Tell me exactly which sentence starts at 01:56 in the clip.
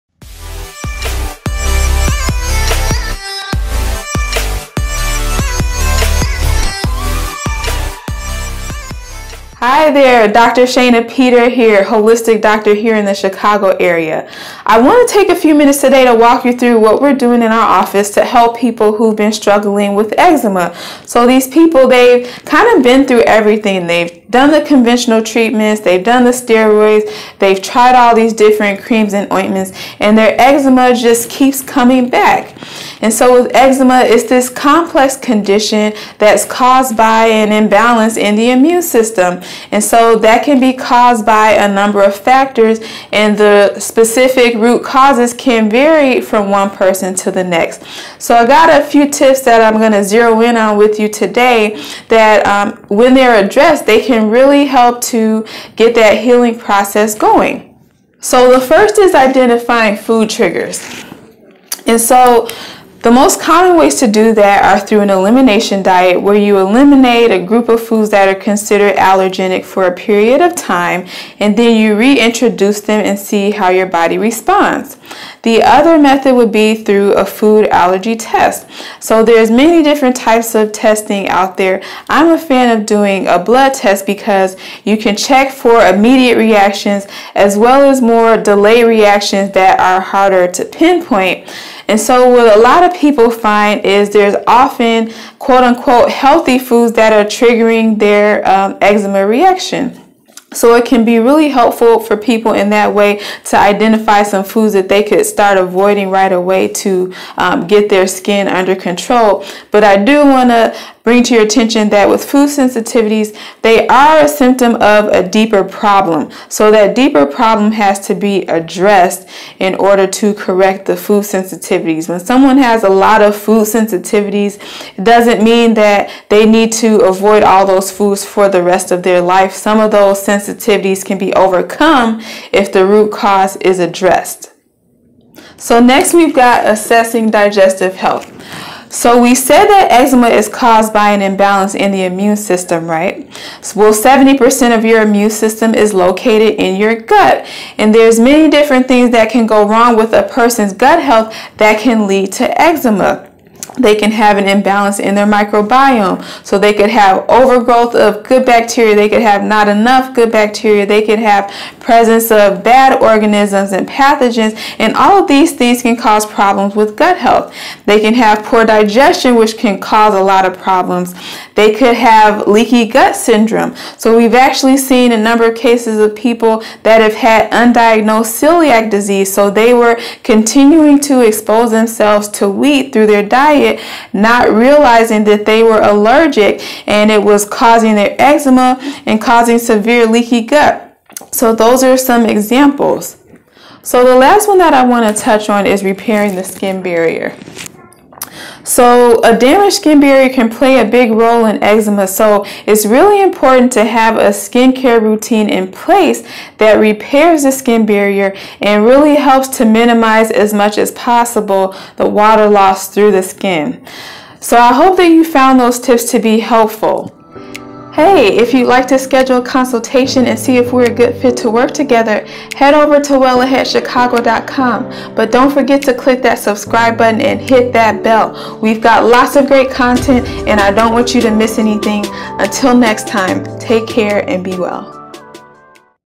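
So that deeper problem has to be addressed in order to correct the food sensitivities.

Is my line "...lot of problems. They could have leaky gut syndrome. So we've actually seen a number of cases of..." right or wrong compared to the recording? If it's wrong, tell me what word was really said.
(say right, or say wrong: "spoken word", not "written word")
right.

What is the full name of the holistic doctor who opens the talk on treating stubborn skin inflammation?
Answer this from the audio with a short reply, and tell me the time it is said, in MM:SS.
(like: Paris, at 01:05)
Shayna Peter, at 00:10.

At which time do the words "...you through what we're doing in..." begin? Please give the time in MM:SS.
00:16.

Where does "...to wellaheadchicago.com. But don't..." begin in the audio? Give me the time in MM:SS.
03:43.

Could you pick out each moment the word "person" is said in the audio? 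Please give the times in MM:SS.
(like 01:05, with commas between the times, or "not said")
00:46, 02:30.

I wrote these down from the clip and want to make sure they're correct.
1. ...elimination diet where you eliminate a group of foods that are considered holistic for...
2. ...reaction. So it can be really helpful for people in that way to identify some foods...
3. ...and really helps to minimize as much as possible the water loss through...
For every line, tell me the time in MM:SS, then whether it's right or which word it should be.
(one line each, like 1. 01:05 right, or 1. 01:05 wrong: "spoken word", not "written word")
1. 01:05 wrong: "allergenic", not "holistic"
2. 01:39 right
3. 03:28 right.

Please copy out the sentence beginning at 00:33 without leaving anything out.
And so with eczema, it's this complex condition that's caused by an imbalance in the immune system.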